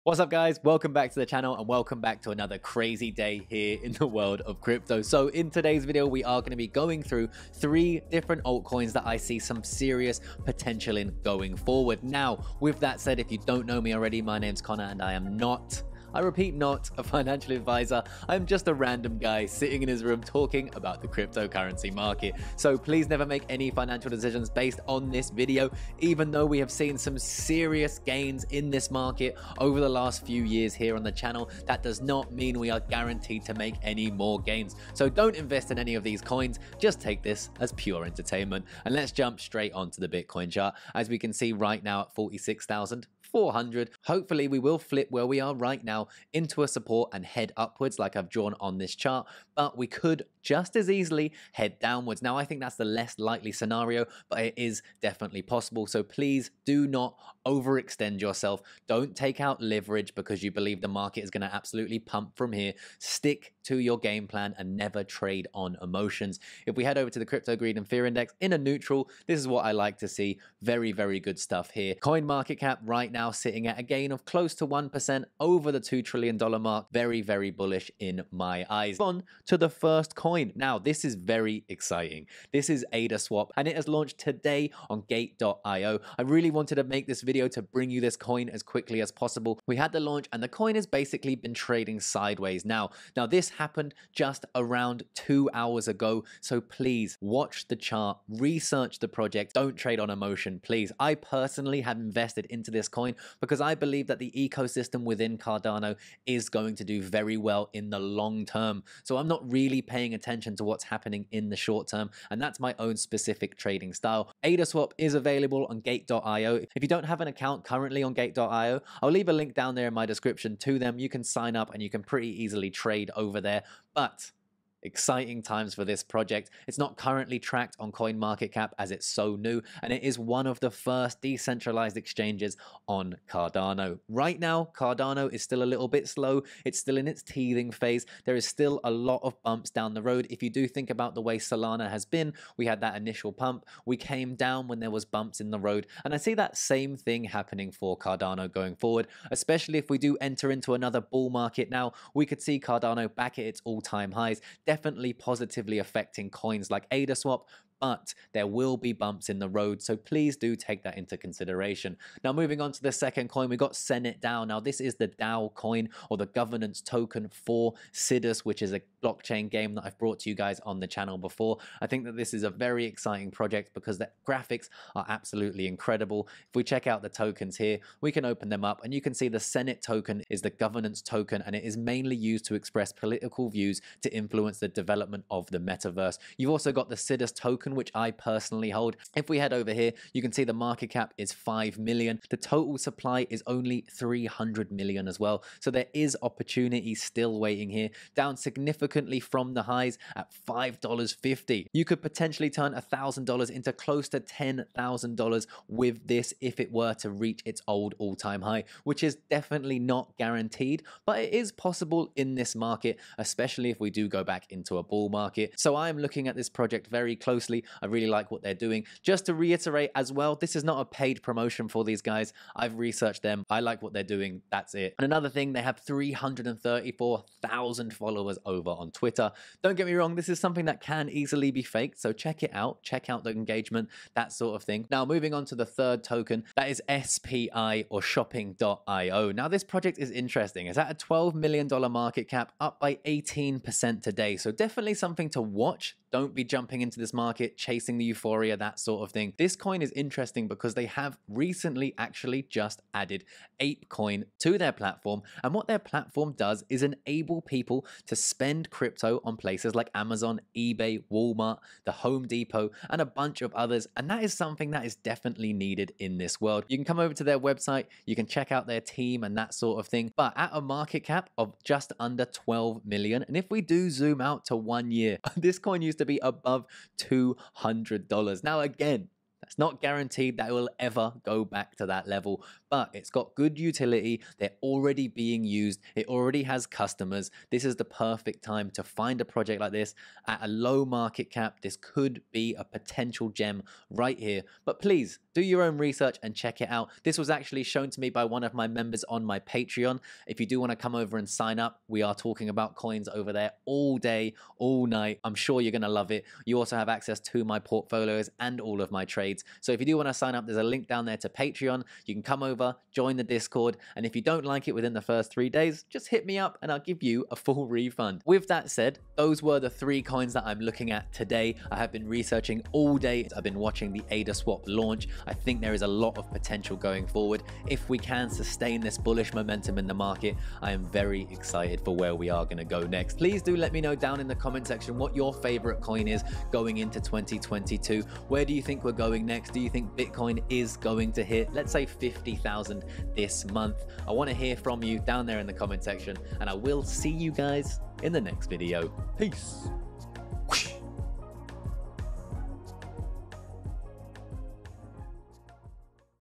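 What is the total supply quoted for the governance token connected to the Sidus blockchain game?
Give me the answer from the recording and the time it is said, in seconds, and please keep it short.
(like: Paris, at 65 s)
300 million, at 193 s.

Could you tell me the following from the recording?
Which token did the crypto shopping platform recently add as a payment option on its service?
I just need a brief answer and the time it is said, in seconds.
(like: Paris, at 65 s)
ApeCoin, at 253 s.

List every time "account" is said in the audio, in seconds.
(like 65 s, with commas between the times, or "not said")
117 s.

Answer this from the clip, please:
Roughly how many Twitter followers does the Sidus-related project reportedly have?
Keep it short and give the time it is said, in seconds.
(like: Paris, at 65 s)
334,000, at 225 s.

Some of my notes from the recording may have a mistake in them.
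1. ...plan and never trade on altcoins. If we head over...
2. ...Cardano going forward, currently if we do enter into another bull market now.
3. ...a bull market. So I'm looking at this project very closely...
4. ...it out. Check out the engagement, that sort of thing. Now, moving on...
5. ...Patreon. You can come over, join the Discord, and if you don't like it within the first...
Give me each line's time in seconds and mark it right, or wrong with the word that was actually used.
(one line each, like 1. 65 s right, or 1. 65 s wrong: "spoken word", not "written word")
1. 64 s wrong: "emotions", not "altcoins"
2. 147 s wrong: "especially", not "currently"
3. 214 s right
4. 232 s right
5. 311 s right.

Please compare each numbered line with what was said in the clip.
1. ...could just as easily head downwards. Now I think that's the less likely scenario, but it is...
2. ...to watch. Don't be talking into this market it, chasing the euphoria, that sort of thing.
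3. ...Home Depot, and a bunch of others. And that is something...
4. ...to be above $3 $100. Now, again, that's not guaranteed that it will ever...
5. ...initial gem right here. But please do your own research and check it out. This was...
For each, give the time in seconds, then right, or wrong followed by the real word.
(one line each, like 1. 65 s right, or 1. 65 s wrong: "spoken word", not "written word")
1. 49 s right
2. 245 s wrong: "jumping", not "talking"
3. 261 s right
4. 275 s wrong: "2", not "3"
5. 292 s wrong: "potential", not "initial".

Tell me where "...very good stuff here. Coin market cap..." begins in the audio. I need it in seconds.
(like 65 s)
70 s.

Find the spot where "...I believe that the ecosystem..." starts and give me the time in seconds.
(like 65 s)
103 s.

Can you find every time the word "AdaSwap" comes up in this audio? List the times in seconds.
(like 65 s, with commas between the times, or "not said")
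114 s, 156 s.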